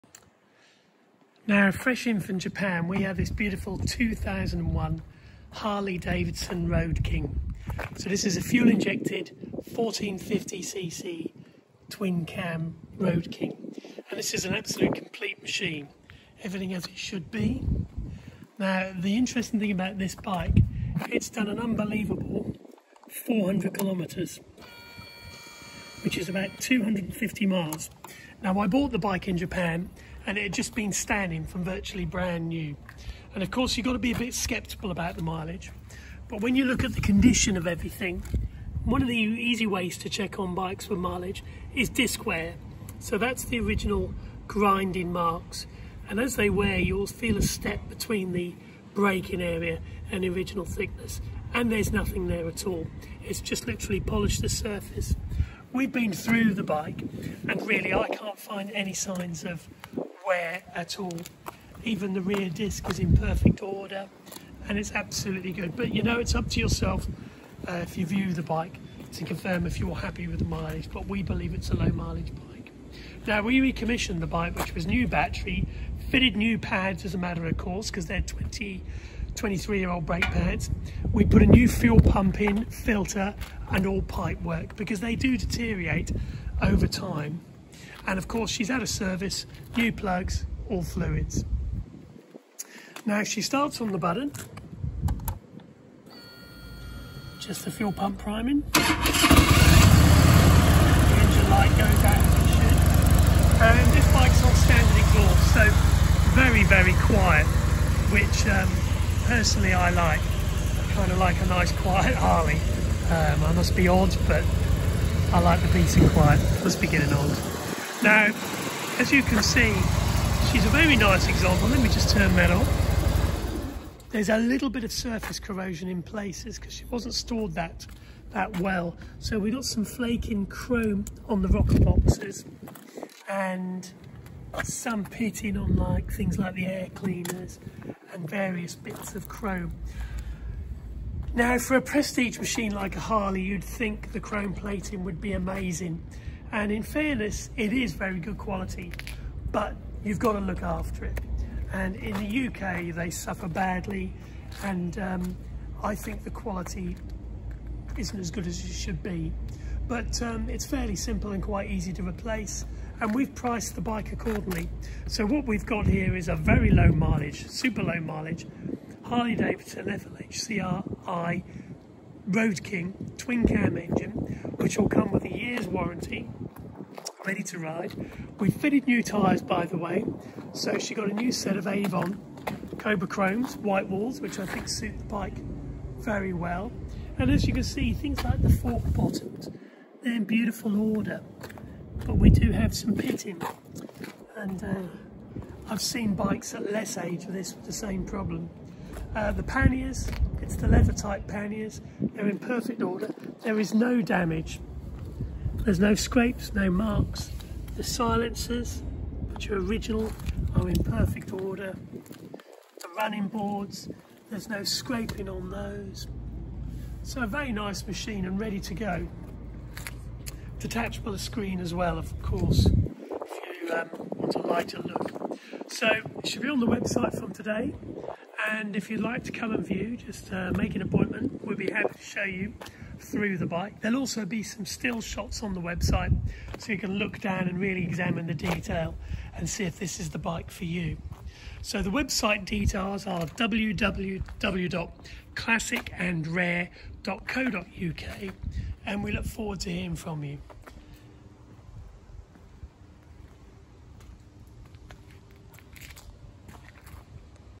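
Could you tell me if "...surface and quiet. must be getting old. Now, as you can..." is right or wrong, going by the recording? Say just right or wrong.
wrong.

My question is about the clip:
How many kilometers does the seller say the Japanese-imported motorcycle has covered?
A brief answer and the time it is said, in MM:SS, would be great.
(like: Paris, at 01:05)
400, at 00:23.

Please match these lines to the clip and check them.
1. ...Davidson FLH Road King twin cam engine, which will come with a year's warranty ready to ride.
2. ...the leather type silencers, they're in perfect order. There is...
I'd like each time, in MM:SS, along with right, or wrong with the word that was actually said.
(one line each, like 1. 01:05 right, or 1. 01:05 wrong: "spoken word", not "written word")
1. 02:49 right
2. 03:20 wrong: "panniers", not "silencers".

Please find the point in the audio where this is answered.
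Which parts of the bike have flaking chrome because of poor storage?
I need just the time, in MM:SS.
02:11.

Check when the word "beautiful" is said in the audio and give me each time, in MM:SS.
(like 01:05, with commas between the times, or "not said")
00:03, 03:10.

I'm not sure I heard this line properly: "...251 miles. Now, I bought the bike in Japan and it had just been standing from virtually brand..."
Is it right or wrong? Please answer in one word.
wrong.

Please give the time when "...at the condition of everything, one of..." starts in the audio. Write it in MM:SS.
00:36.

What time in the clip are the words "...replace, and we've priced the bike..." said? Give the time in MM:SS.
02:42.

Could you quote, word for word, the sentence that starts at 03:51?
we would be happy to show you through the bike.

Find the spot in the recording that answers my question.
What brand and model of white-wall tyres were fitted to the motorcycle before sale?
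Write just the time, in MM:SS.
03:01.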